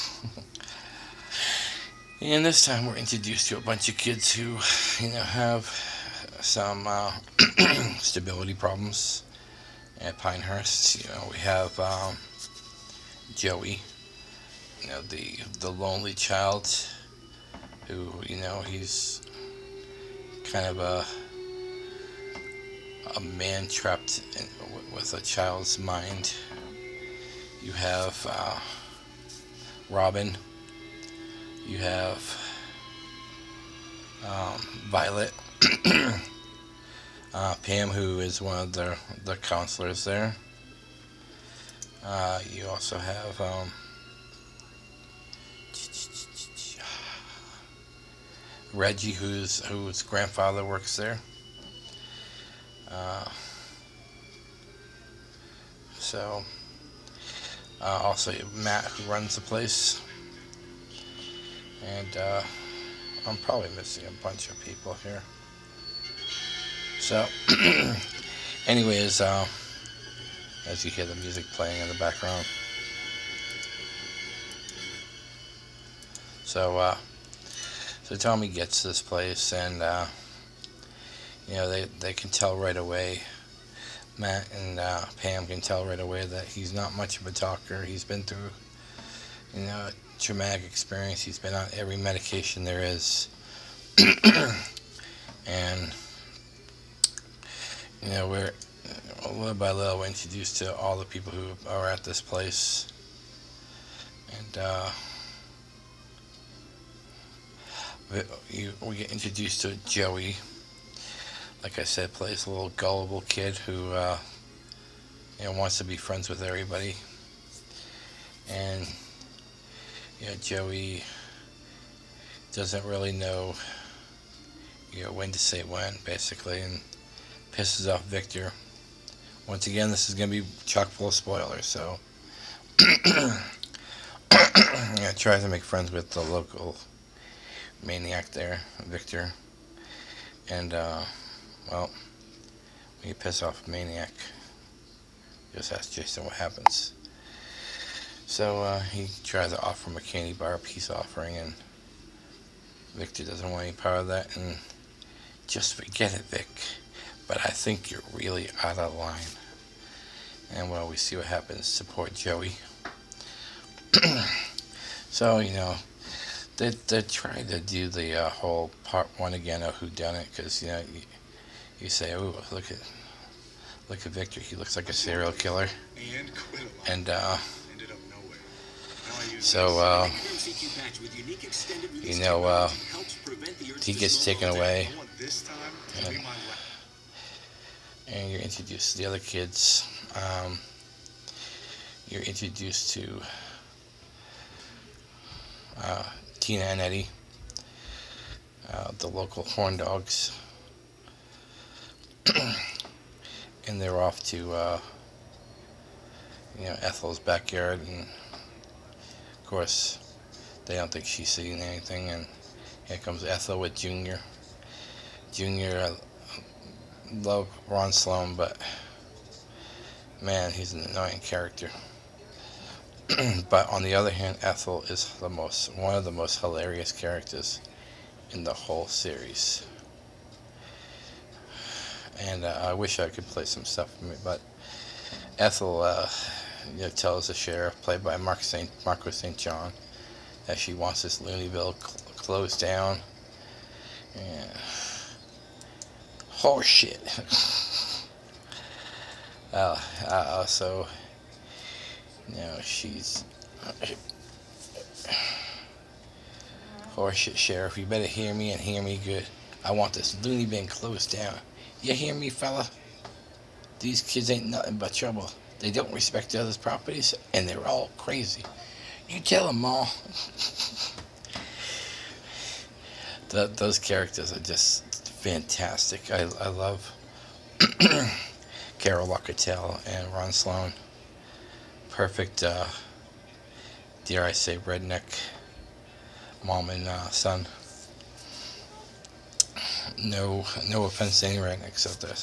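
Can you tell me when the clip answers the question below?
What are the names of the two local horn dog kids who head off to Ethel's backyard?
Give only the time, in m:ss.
3:16.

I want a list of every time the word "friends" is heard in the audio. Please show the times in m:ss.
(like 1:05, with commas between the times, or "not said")
1:55, 2:15.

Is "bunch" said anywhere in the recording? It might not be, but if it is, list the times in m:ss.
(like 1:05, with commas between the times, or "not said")
0:03, 1:04.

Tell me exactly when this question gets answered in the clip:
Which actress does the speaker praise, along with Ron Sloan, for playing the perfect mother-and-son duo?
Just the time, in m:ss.
4:38.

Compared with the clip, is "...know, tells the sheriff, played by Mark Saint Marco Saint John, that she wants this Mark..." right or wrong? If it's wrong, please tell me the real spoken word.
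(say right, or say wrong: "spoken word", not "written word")
wrong: "Looneyville", not "Mark".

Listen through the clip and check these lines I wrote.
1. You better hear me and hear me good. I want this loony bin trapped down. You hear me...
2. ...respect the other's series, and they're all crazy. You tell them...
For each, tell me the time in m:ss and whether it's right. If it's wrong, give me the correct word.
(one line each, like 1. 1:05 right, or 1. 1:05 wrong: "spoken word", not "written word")
1. 4:17 wrong: "closed", not "trapped"
2. 4:25 wrong: "properties", not "series".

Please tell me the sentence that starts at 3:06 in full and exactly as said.
And, and, you're introduced to the other kids.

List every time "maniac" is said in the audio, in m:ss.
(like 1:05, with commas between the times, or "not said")
2:17, 2:23.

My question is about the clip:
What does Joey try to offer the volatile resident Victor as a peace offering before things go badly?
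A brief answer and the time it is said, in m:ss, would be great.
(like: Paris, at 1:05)
A candy bar, at 2:29.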